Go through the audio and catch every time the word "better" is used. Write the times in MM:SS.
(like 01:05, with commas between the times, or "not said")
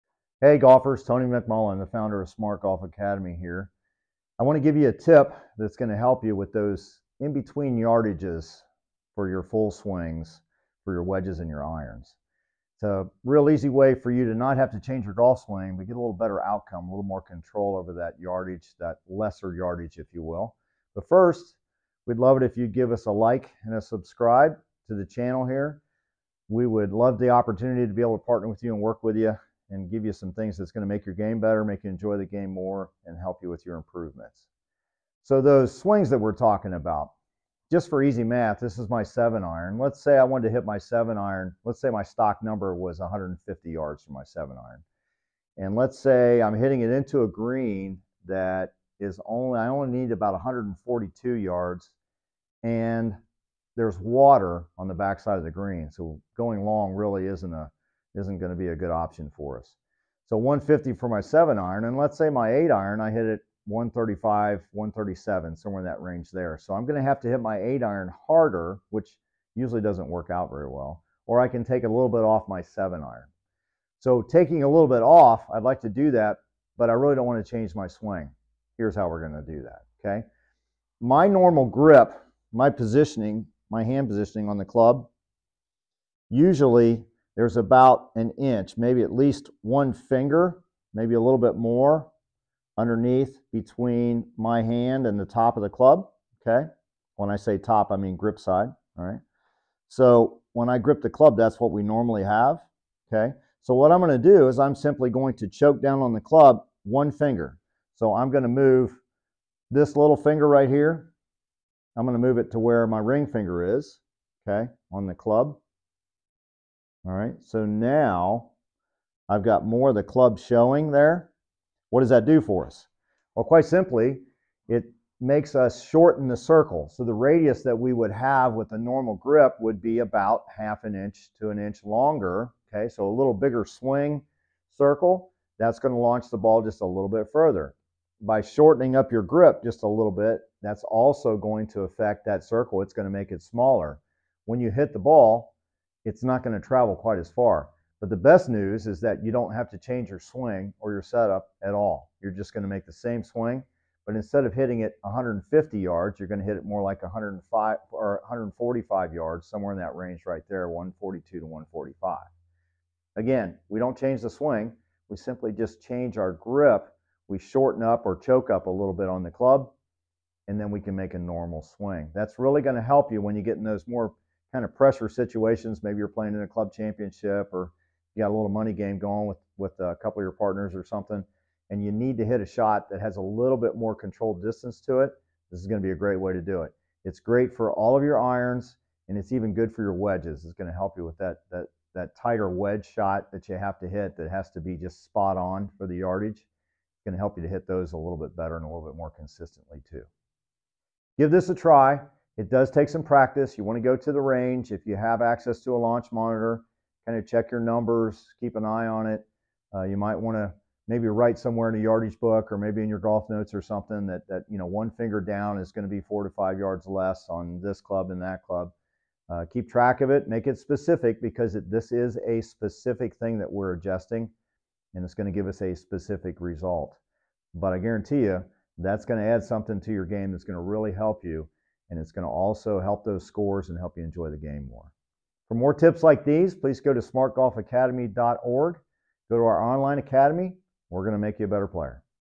00:16, 00:31, 03:18, 04:01.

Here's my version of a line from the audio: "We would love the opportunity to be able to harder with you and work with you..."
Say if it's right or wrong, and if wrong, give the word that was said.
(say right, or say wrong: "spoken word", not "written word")
wrong: "partner", not "harder".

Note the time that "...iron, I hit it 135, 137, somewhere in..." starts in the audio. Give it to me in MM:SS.
01:02.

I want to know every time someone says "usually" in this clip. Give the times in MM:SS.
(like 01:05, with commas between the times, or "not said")
01:09, 01:26.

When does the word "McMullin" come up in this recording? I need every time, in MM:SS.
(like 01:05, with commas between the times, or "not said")
00:01.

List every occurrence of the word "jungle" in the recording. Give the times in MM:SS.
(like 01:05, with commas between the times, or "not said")
not said.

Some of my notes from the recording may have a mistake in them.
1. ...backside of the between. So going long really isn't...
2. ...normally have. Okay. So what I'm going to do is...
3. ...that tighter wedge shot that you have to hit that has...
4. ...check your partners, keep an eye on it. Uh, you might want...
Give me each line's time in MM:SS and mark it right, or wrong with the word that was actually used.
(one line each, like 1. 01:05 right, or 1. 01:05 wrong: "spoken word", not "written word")
1. 00:54 wrong: "green", not "between"
2. 01:41 right
3. 03:11 right
4. 03:27 wrong: "numbers", not "partners".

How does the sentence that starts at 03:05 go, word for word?
This is going to be a great way to do it.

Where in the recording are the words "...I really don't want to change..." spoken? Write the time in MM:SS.
01:16.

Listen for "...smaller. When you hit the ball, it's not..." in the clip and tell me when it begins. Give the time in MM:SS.
02:23.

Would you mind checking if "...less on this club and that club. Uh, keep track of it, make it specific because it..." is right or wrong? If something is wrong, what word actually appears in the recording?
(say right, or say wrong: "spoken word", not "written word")
right.